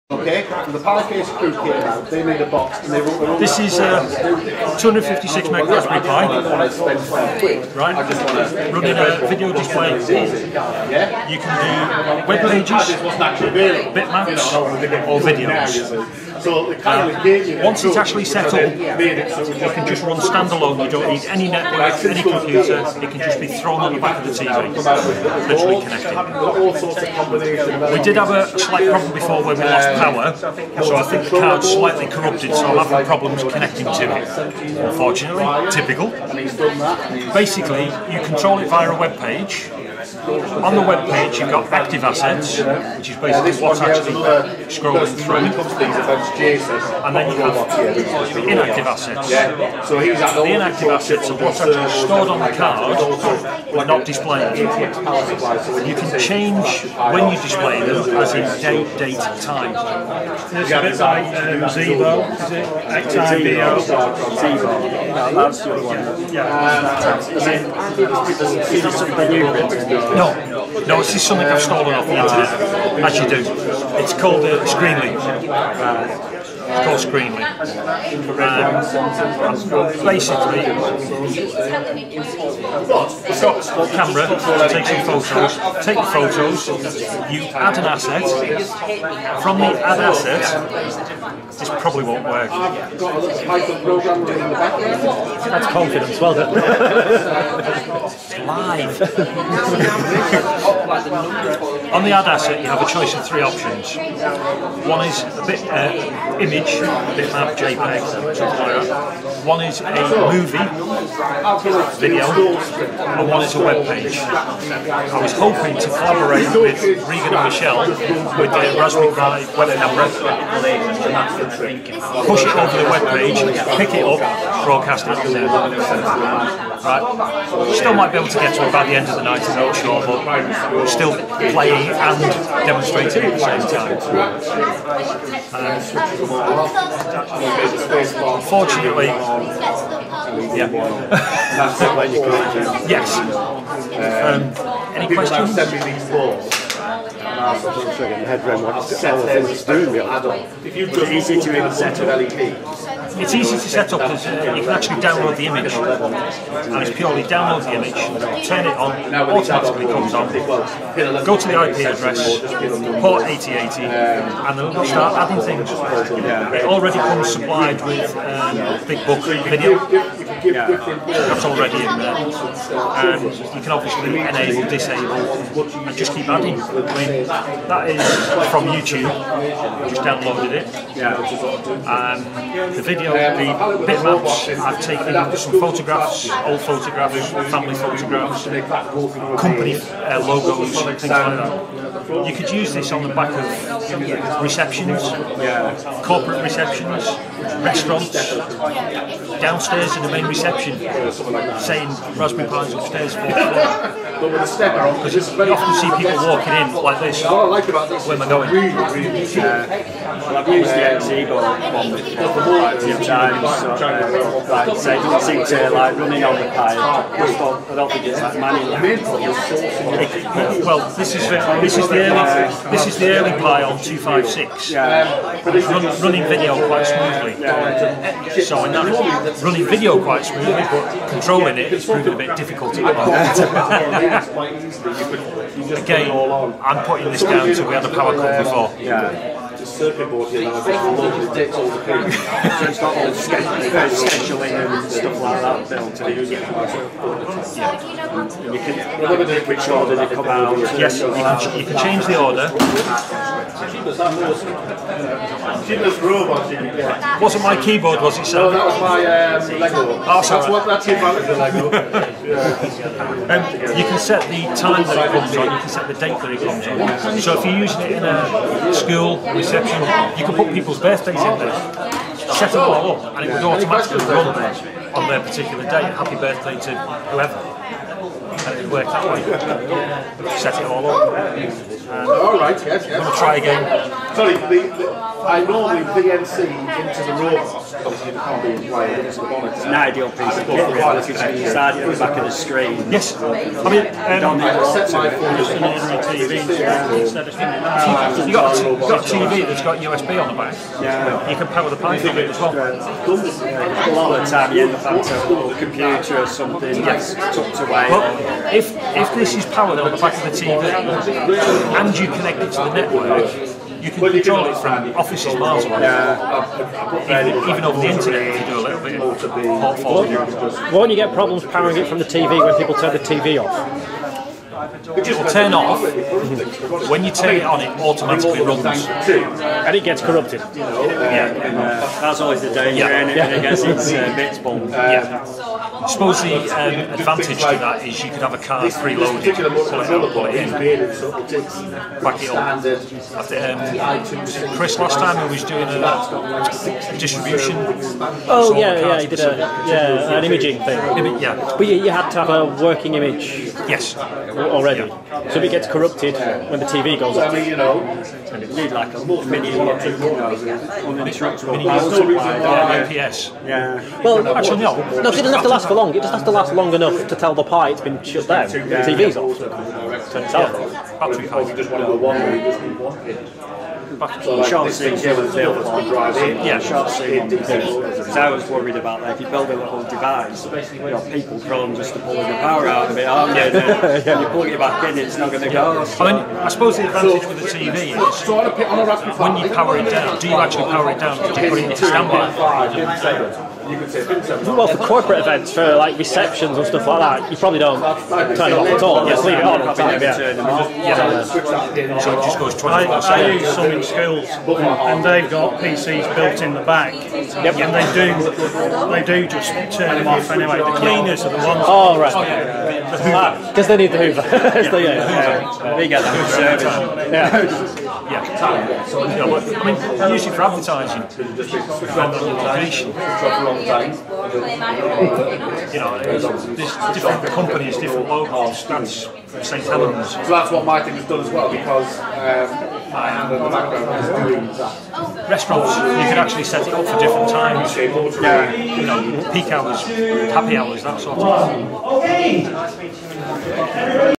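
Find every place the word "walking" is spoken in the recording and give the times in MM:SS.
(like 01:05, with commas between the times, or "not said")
03:26.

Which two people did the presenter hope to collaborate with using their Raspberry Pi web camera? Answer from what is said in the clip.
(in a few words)
Regan and Michelle.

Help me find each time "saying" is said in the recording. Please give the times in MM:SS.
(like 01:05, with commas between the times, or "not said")
03:21.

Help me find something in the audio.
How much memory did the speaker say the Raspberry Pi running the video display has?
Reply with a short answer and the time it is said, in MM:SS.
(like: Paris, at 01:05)
256 meg, at 00:04.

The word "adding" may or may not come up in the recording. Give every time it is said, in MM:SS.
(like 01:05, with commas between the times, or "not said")
02:45, 02:56.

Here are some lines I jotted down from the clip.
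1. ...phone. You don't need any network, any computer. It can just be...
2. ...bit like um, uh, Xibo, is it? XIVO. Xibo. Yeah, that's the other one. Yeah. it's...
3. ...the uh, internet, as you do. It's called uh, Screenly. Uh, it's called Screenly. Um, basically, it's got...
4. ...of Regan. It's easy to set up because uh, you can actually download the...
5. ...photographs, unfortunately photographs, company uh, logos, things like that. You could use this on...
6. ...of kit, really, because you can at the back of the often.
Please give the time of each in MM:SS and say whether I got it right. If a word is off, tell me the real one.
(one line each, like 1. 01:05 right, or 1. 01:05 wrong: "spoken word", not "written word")
1. 00:20 wrong: "standalone", not "phone"
2. 01:00 right
3. 01:12 right
4. 02:31 wrong: "LED", not "Regan"
5. 03:06 wrong: "family", not "unfortunately"
6. 04:50 wrong: "screen", not "often".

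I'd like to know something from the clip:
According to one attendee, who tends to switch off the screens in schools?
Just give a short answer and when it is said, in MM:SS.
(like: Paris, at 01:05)
The cleaners, at 06:50.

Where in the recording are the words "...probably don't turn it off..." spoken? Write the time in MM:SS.
06:37.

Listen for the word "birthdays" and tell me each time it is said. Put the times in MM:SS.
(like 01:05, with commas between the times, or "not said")
04:30, 04:36.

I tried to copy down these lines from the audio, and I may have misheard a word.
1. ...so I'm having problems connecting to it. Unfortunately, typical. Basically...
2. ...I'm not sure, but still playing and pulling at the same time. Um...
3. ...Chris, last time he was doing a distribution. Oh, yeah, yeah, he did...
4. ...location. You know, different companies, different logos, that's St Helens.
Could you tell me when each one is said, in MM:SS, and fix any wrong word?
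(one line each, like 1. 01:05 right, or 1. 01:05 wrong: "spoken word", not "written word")
1. 00:32 right
2. 02:09 wrong: "demonstrating", not "pulling"
3. 05:44 right
4. 07:02 right.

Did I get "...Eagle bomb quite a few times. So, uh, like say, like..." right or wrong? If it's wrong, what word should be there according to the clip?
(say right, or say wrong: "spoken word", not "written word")
right.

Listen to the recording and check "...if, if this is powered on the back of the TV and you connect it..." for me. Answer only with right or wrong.
right.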